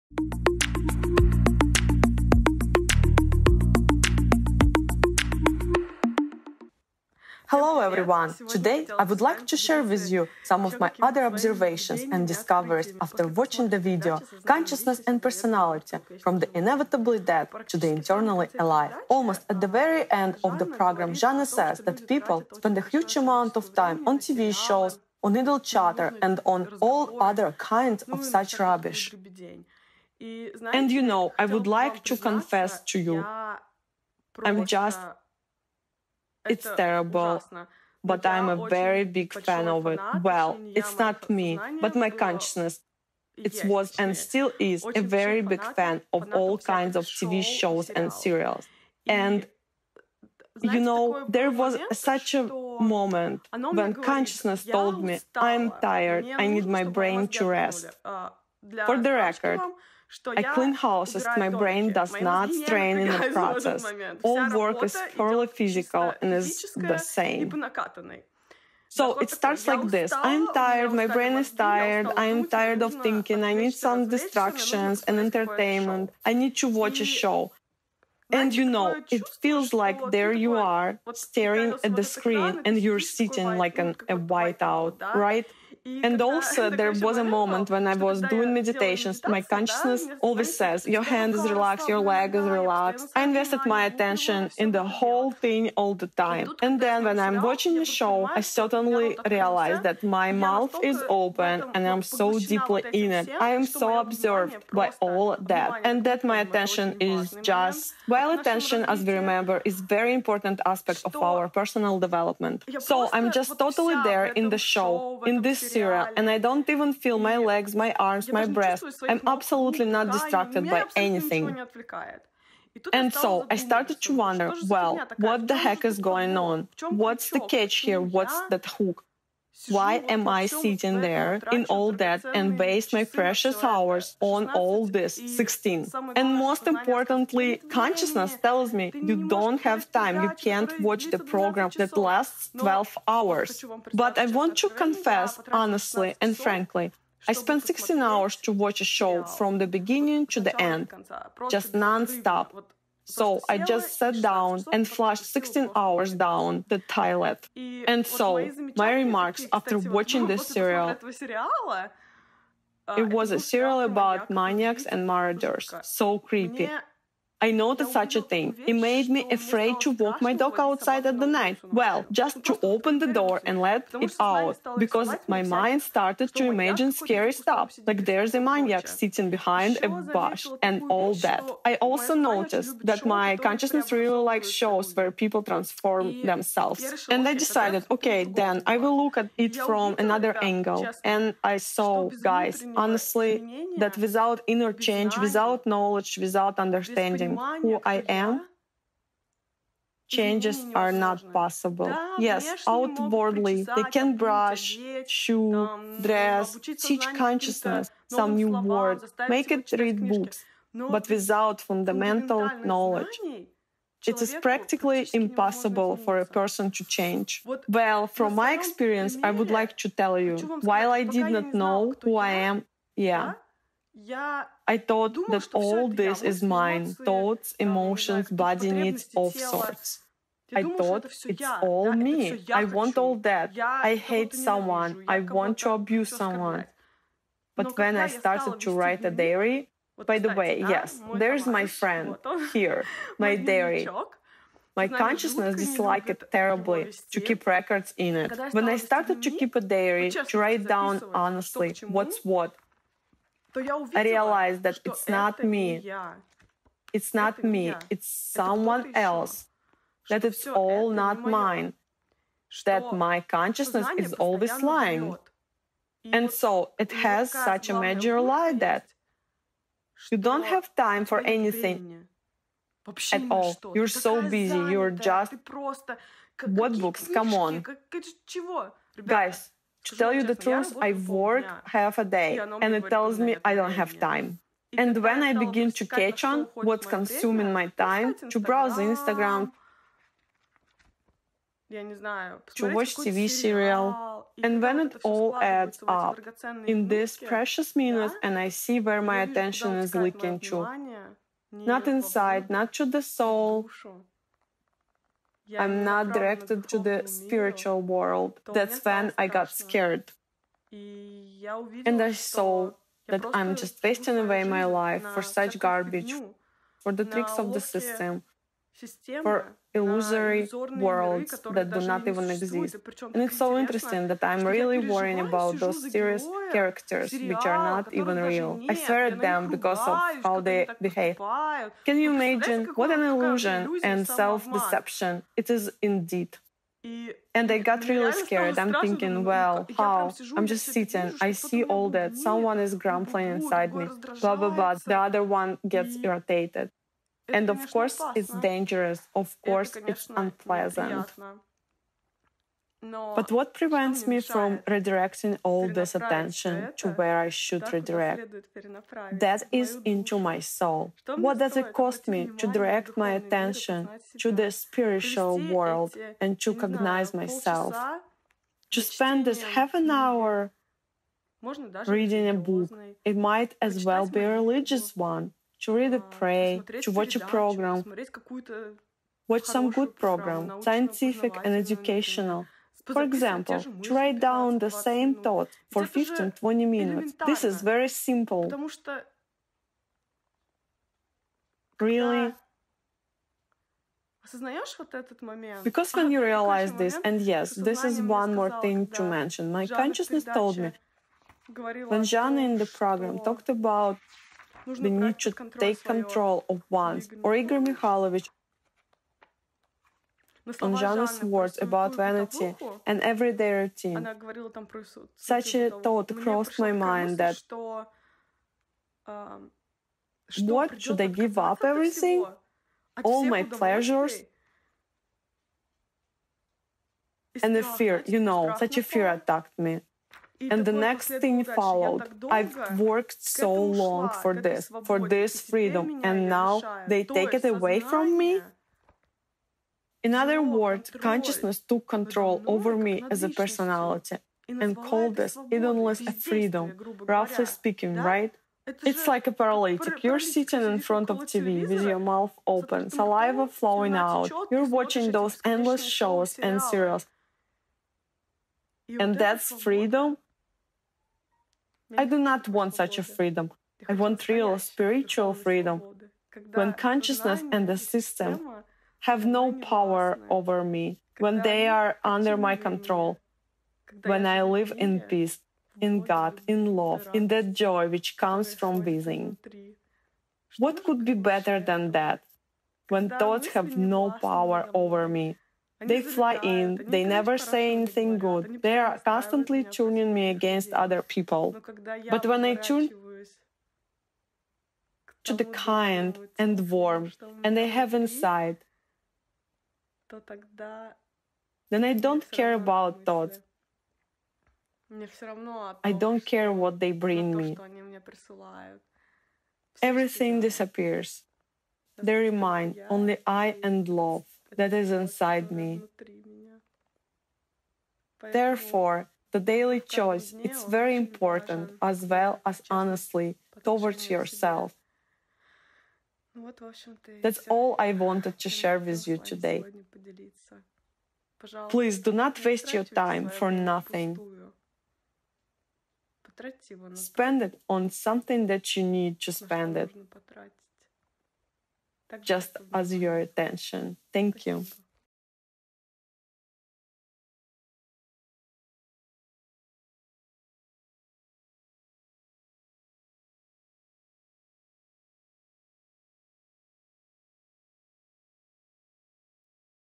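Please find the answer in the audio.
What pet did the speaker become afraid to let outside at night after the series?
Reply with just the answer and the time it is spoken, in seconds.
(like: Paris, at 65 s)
Dog, at 170 s.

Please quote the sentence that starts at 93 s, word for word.
I invested my attention in the whole thing all the time.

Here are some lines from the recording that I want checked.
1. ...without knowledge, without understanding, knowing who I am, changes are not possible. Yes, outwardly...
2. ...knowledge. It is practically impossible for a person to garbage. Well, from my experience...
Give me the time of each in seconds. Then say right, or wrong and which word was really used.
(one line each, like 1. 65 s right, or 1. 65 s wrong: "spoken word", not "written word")
1. 195 s right
2. 212 s wrong: "change", not "garbage".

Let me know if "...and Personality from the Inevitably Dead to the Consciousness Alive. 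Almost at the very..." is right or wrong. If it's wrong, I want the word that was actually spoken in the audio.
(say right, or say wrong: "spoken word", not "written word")
wrong: "Eternally", not "Consciousness".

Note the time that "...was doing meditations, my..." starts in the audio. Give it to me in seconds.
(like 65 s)
87 s.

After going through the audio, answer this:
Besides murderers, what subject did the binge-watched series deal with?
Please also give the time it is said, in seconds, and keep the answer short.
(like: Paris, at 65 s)
Maniacs, at 164 s.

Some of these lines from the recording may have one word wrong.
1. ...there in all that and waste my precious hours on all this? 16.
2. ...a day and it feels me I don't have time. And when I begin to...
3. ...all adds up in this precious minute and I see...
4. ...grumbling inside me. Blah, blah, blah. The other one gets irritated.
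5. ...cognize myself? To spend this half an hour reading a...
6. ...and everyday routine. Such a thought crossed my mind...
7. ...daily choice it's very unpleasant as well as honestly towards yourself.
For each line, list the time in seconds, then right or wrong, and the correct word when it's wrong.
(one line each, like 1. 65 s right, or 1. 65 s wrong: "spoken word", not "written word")
1. 131 s right
2. 281 s wrong: "tells", not "feels"
3. 295 s right
4. 342 s right
5. 366 s right
6. 412 s right
7. 519 s wrong: "important", not "unpleasant".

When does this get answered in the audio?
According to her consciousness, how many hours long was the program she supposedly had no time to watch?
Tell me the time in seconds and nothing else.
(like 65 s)
142 s.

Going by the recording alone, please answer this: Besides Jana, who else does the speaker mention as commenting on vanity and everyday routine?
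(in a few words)
Igor Mikhailovich.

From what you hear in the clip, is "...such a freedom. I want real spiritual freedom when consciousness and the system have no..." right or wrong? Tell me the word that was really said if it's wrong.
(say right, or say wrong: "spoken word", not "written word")
right.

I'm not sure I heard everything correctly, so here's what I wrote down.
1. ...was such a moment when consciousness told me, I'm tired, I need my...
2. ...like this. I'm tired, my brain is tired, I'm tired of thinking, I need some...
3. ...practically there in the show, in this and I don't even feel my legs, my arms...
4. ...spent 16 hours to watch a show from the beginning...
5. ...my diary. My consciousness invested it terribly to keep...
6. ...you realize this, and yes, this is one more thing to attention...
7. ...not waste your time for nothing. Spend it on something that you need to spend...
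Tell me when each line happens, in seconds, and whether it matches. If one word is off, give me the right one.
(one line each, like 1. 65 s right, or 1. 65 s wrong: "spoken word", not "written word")
1. 51 s right
2. 69 s right
3. 113 s wrong: "totally", not "practically"
4. 147 s right
5. 243 s wrong: "disliked", not "invested"
6. 396 s wrong: "mention", not "attention"
7. 532 s right.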